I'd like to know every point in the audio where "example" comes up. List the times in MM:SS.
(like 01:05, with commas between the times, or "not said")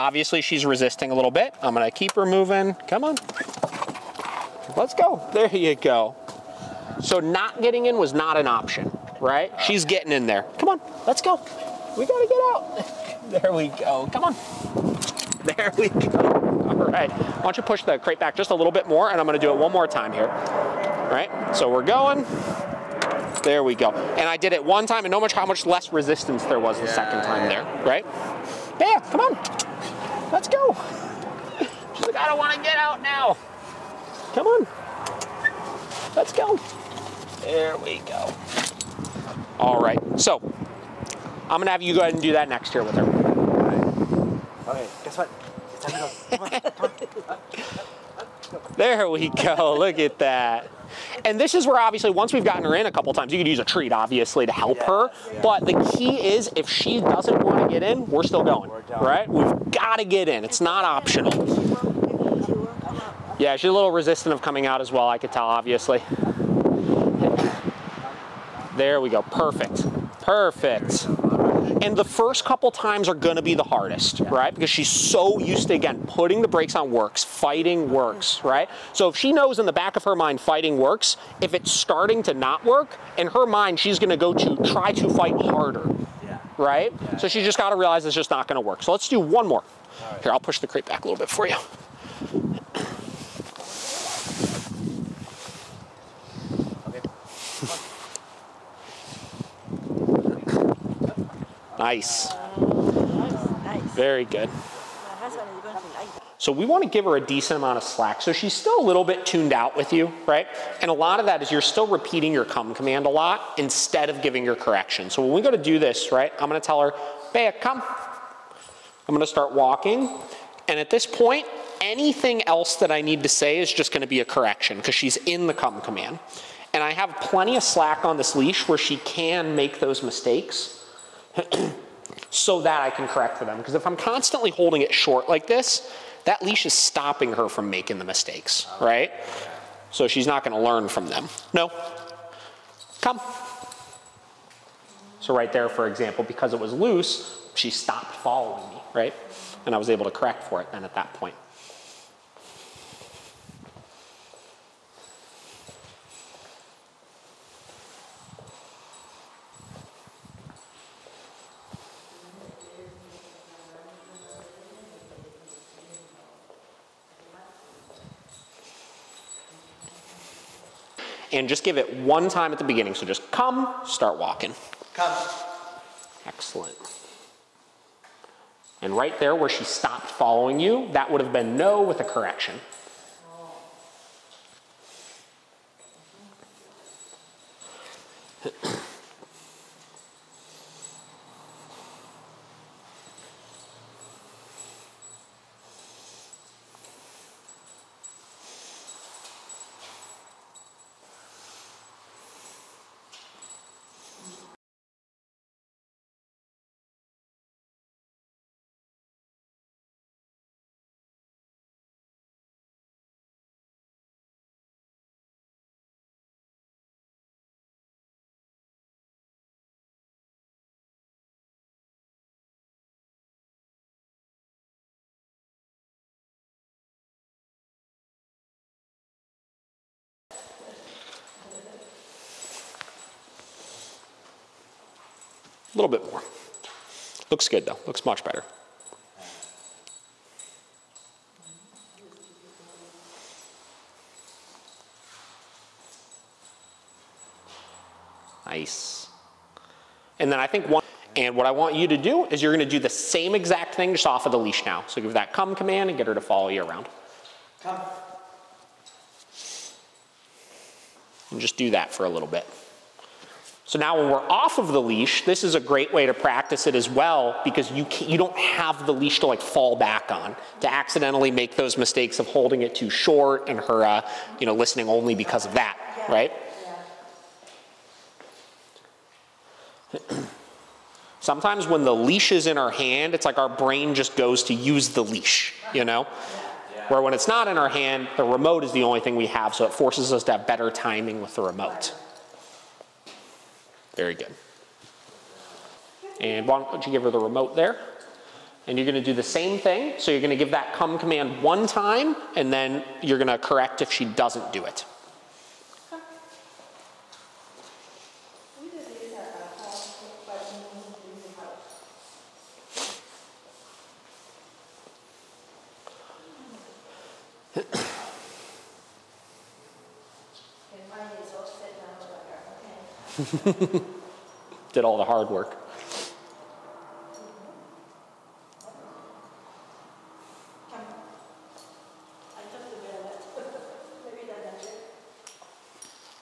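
02:25.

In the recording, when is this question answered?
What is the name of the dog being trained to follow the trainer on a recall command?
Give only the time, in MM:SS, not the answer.
01:57.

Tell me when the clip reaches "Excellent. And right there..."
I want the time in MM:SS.
02:56.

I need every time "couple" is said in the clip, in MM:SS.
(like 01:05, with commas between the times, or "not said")
00:52, 01:12.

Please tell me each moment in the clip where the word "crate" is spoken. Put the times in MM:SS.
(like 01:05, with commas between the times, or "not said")
00:17, 01:30.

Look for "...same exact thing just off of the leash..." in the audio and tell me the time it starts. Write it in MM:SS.
04:12.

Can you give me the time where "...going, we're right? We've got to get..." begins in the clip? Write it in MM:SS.
00:58.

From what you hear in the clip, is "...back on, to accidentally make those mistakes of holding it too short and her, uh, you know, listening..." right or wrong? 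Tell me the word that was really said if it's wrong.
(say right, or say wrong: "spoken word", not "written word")
right.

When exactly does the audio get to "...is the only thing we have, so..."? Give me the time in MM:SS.
04:48.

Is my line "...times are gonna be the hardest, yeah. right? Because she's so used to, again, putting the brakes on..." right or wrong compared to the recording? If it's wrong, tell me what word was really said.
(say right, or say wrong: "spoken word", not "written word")
right.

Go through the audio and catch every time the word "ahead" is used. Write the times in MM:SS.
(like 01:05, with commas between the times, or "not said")
00:42.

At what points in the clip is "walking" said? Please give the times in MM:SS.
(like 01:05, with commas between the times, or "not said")
01:59, 02:54.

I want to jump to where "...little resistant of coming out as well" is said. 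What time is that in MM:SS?
01:03.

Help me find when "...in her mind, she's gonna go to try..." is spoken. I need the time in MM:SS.
01:23.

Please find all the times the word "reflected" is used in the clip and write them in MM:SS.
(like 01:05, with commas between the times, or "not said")
not said.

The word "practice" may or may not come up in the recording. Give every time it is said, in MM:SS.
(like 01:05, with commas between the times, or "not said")
04:26.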